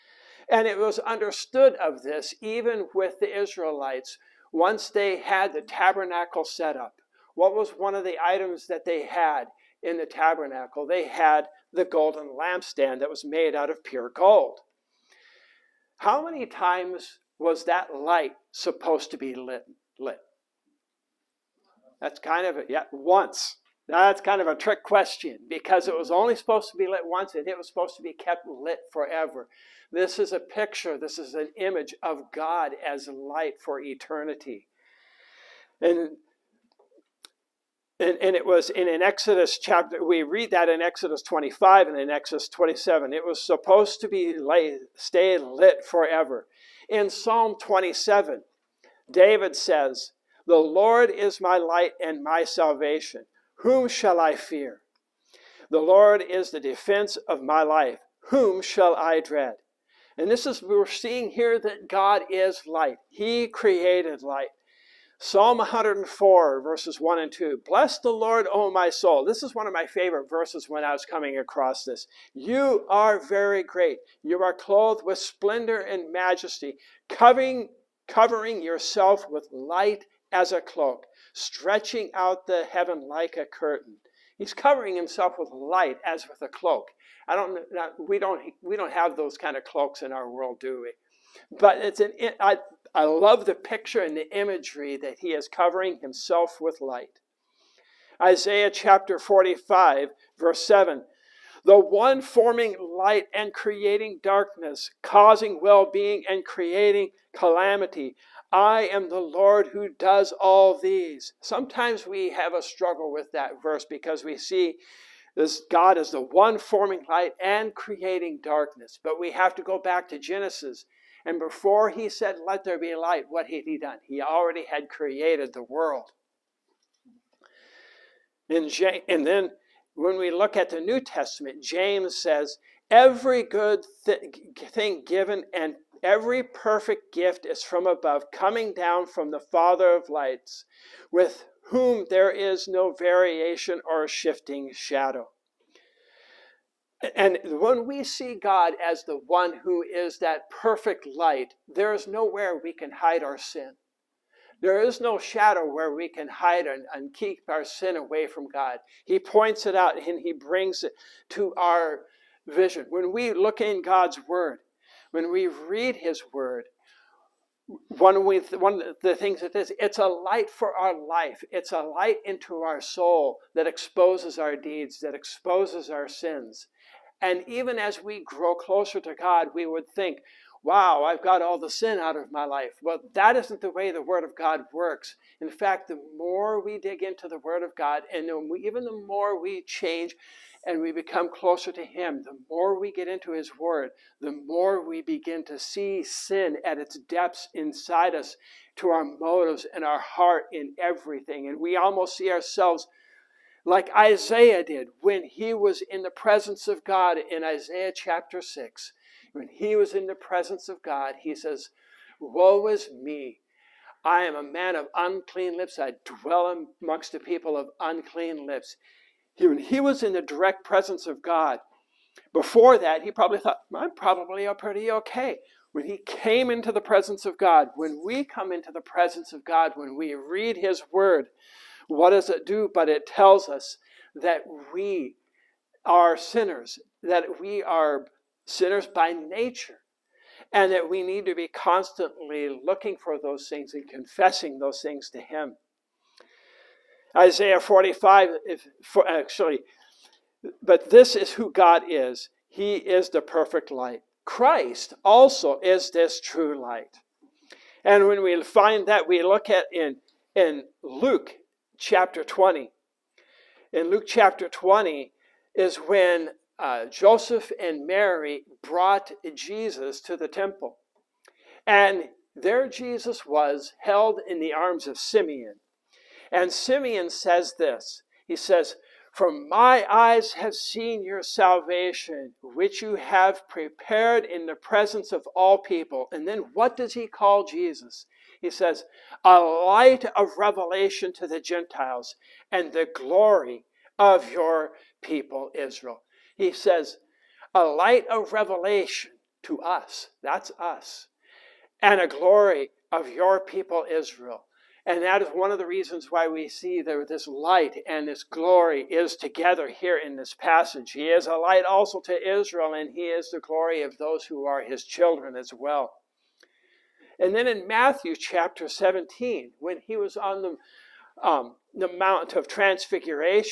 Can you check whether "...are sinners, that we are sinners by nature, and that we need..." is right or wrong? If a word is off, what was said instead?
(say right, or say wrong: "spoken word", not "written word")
right.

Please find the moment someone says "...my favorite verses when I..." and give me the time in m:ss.
1:09.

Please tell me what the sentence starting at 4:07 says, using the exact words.
Isaiah 45, if, for, actually, but this is who God is.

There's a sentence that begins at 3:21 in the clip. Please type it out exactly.
And we almost see ourselves like Isaiah did when he was in the presence of God in Isaiah chapter 6.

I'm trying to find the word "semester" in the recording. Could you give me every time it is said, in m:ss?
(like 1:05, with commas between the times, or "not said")
not said.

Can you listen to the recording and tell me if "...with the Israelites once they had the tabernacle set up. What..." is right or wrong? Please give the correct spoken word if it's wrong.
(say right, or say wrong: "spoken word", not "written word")
right.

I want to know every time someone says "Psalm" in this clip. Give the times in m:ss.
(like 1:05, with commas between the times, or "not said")
0:47, 1:05.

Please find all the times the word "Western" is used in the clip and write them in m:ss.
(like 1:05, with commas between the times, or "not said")
not said.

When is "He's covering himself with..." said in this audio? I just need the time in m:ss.
1:24.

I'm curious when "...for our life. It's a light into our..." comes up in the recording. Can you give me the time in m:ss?
2:50.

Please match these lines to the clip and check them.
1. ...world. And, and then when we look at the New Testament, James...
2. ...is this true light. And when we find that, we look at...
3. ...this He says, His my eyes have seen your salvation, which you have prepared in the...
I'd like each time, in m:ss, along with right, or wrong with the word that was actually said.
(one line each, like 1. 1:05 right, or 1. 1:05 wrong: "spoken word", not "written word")
1. 2:05 right
2. 4:15 right
3. 4:37 wrong: "For", not "His".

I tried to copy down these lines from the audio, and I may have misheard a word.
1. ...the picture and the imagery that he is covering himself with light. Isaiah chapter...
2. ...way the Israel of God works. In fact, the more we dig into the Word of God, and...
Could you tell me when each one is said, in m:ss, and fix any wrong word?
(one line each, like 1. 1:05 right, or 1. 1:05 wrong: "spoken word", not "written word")
1. 1:33 right
2. 3:03 wrong: "Word", not "Israel".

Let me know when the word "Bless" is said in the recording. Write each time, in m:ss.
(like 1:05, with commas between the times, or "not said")
1:07.